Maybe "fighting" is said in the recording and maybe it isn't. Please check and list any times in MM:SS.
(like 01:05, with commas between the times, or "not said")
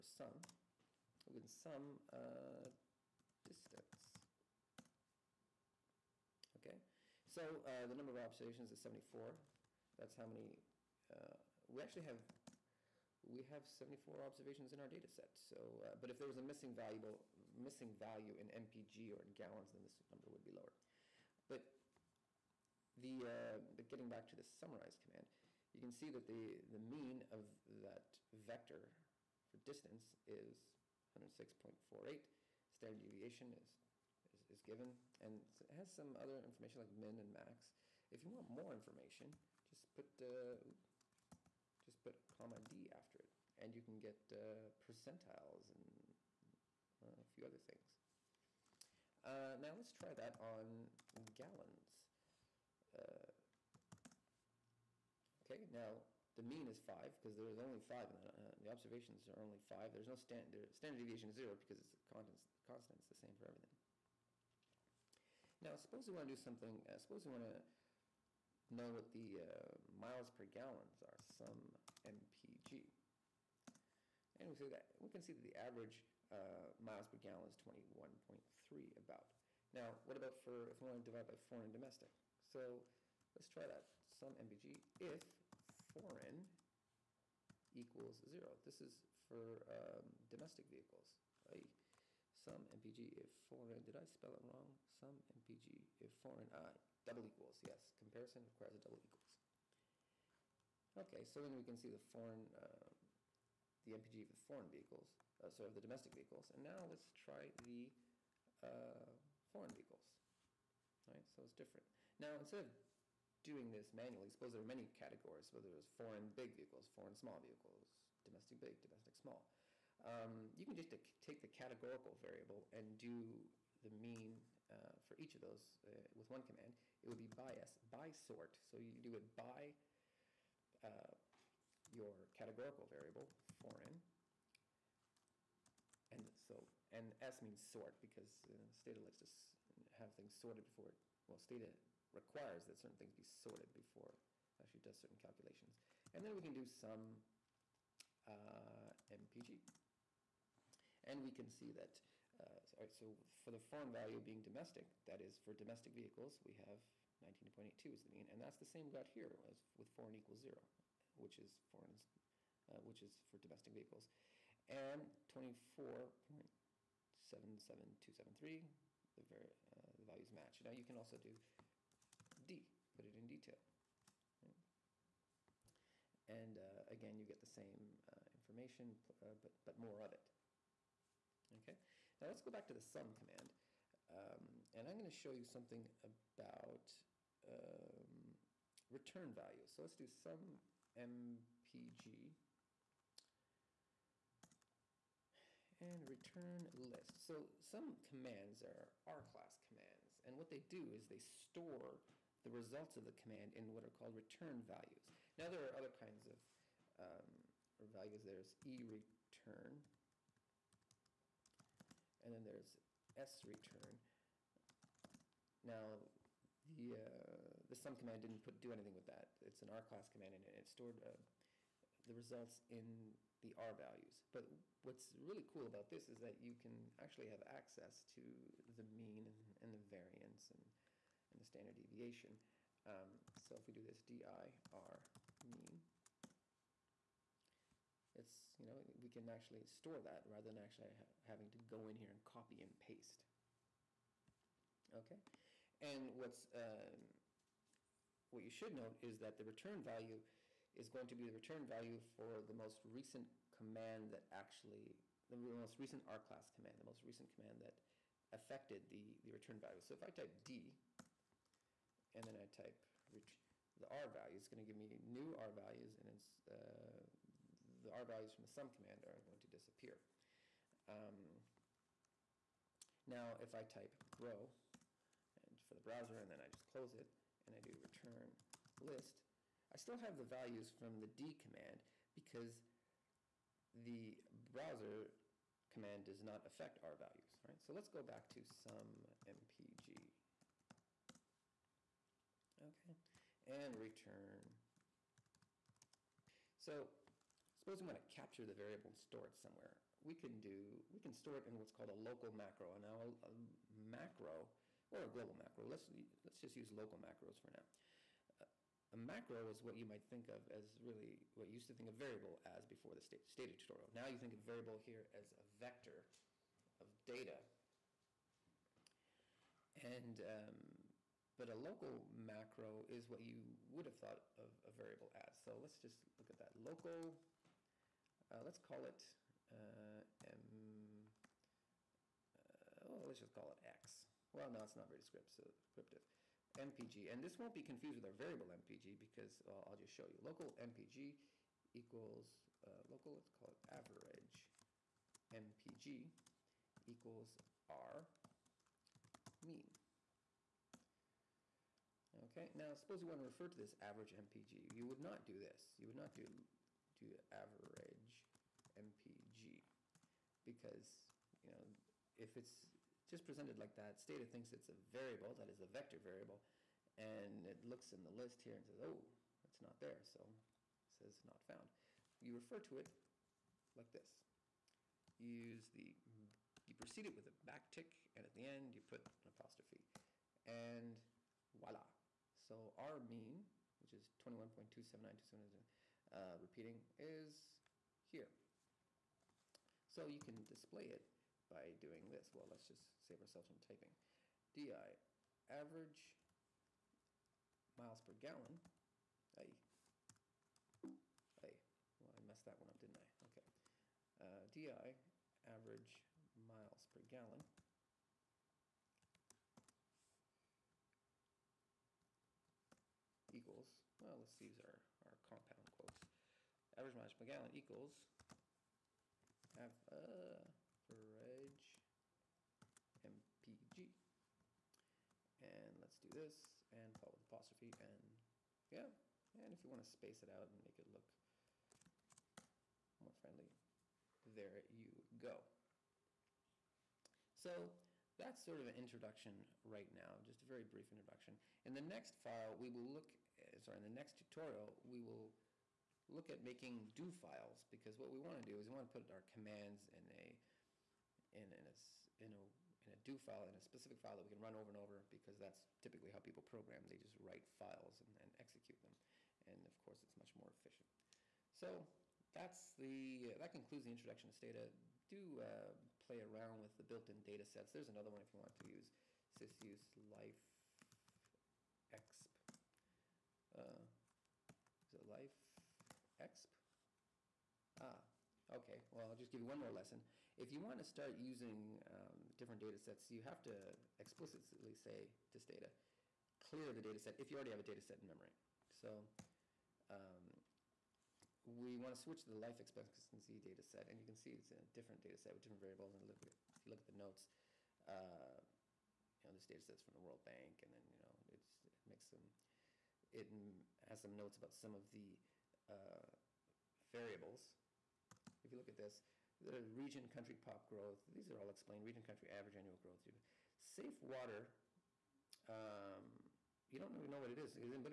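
not said.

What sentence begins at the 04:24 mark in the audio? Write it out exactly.
It's going to give me new R values, and it's, uh, the R values from the sum command are going to disappear.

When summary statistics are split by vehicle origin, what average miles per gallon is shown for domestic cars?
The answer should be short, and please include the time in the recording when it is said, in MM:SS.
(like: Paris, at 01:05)
19.82, at 02:37.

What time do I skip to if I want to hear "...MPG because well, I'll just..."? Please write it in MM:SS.
05:38.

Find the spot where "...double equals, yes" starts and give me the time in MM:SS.
01:37.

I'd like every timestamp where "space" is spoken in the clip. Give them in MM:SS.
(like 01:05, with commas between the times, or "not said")
07:09.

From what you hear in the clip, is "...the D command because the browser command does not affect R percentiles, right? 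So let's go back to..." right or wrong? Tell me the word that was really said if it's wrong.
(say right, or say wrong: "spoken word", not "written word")
wrong: "values", not "percentiles".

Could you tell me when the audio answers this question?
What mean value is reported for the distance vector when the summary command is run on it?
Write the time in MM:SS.
00:31.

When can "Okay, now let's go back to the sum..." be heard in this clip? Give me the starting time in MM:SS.
03:01.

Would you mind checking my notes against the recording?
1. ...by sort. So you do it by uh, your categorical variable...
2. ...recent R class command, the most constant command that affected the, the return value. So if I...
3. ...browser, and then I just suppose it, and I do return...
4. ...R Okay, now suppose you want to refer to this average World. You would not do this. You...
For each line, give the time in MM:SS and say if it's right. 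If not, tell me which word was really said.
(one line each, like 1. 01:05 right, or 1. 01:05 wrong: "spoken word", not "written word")
1. 02:07 right
2. 04:15 wrong: "recent", not "constant"
3. 04:35 wrong: "close", not "suppose"
4. 05:47 wrong: "MPG", not "World".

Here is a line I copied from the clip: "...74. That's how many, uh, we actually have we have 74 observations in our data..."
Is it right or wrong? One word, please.
right.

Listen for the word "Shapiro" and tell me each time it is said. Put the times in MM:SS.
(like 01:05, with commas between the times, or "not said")
not said.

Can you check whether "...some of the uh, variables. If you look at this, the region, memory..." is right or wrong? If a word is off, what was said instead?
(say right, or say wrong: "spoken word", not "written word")
wrong: "country", not "memory".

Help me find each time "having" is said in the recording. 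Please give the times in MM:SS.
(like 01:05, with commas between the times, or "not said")
04:01.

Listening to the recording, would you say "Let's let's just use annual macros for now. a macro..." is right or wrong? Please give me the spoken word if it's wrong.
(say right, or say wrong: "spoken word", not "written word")
wrong: "local", not "annual".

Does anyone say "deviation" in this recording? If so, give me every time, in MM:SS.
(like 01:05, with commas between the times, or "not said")
00:33, 01:00, 03:51.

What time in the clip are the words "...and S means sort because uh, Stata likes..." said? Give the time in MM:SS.
02:16.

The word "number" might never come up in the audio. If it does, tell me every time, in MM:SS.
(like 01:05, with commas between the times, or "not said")
00:07, 00:20.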